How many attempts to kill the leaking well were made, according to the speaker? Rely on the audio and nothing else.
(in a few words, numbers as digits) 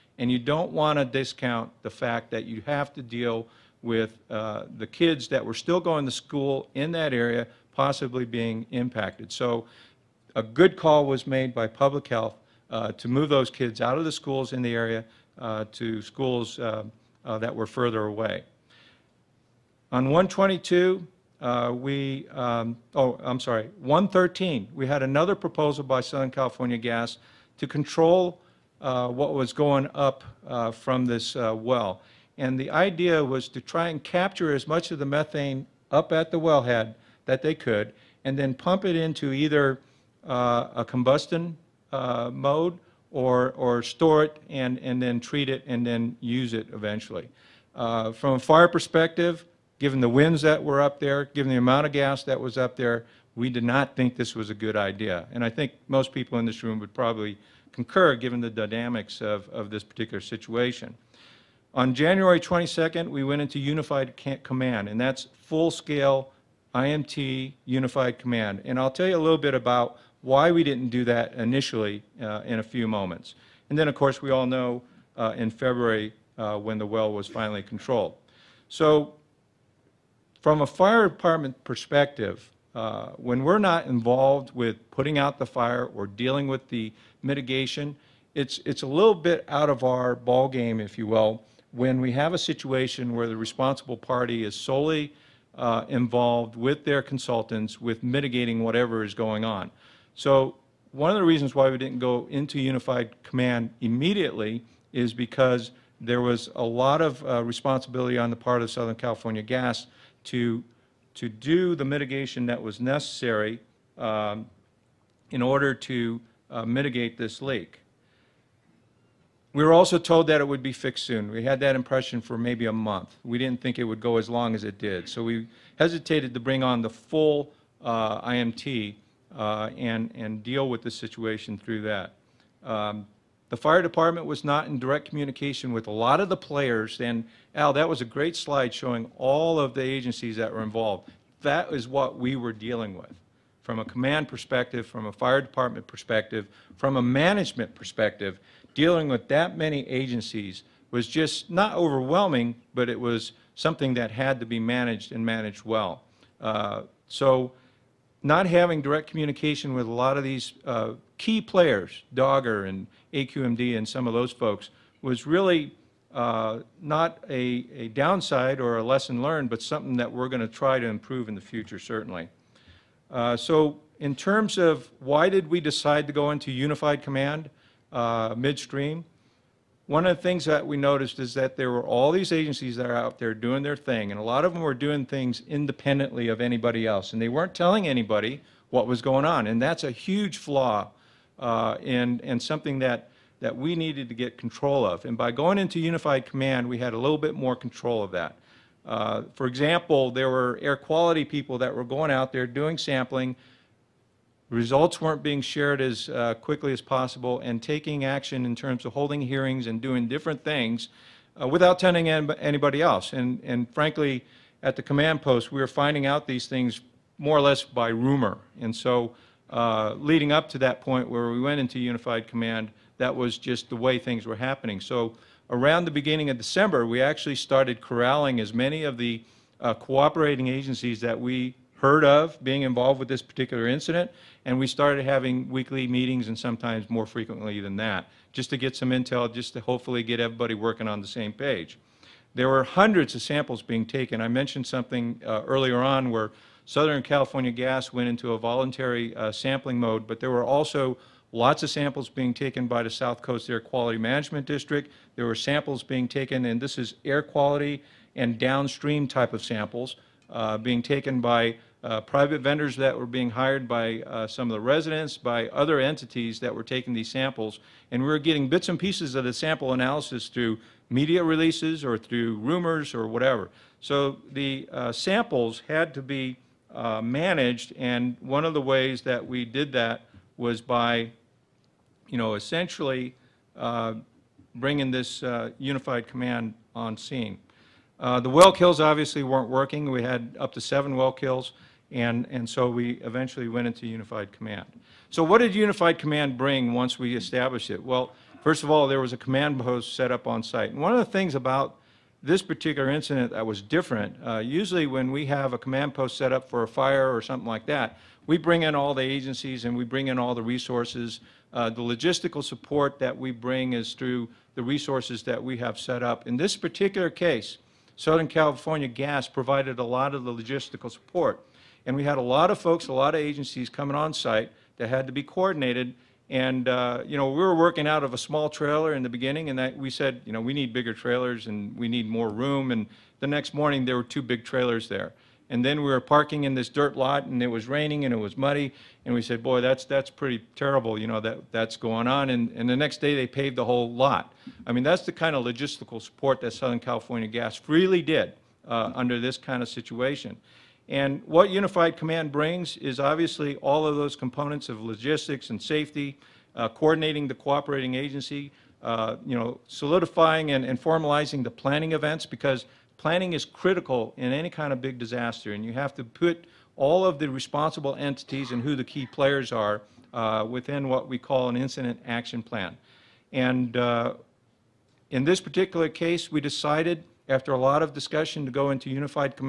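7.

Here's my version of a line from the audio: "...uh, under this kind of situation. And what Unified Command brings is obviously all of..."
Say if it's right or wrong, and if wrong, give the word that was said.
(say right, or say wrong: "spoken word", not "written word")
right.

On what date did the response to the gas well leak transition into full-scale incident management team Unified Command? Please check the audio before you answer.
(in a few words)
January 22nd.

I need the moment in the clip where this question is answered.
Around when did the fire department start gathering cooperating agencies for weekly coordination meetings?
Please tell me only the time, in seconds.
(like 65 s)
225 s.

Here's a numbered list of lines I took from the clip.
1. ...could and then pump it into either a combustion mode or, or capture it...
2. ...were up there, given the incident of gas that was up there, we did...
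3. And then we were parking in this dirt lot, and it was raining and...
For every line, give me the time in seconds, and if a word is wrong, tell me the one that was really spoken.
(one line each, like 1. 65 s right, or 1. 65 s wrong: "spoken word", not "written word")
1. 37 s wrong: "store", not "capture"
2. 50 s wrong: "amount", not "incident"
3. 335 s right.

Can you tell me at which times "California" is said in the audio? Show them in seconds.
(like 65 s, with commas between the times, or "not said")
26 s, 108 s, 247 s, 318 s, 346 s.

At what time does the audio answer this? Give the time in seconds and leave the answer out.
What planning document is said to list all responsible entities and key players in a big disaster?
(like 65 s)
371 s.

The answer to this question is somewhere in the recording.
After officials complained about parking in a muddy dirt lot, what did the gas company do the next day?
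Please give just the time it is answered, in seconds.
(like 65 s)
343 s.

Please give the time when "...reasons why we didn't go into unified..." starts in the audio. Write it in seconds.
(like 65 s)
101 s.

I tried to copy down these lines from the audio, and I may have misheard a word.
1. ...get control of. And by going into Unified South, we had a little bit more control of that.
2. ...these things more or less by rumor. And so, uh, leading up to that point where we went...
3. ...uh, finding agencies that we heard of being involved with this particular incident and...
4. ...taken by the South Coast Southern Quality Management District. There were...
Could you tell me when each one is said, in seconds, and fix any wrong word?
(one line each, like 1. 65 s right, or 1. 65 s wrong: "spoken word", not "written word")
1. 194 s wrong: "Command", not "South"
2. 216 s right
3. 229 s wrong: "cooperating", not "finding"
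4. 252 s wrong: "Air", not "Southern".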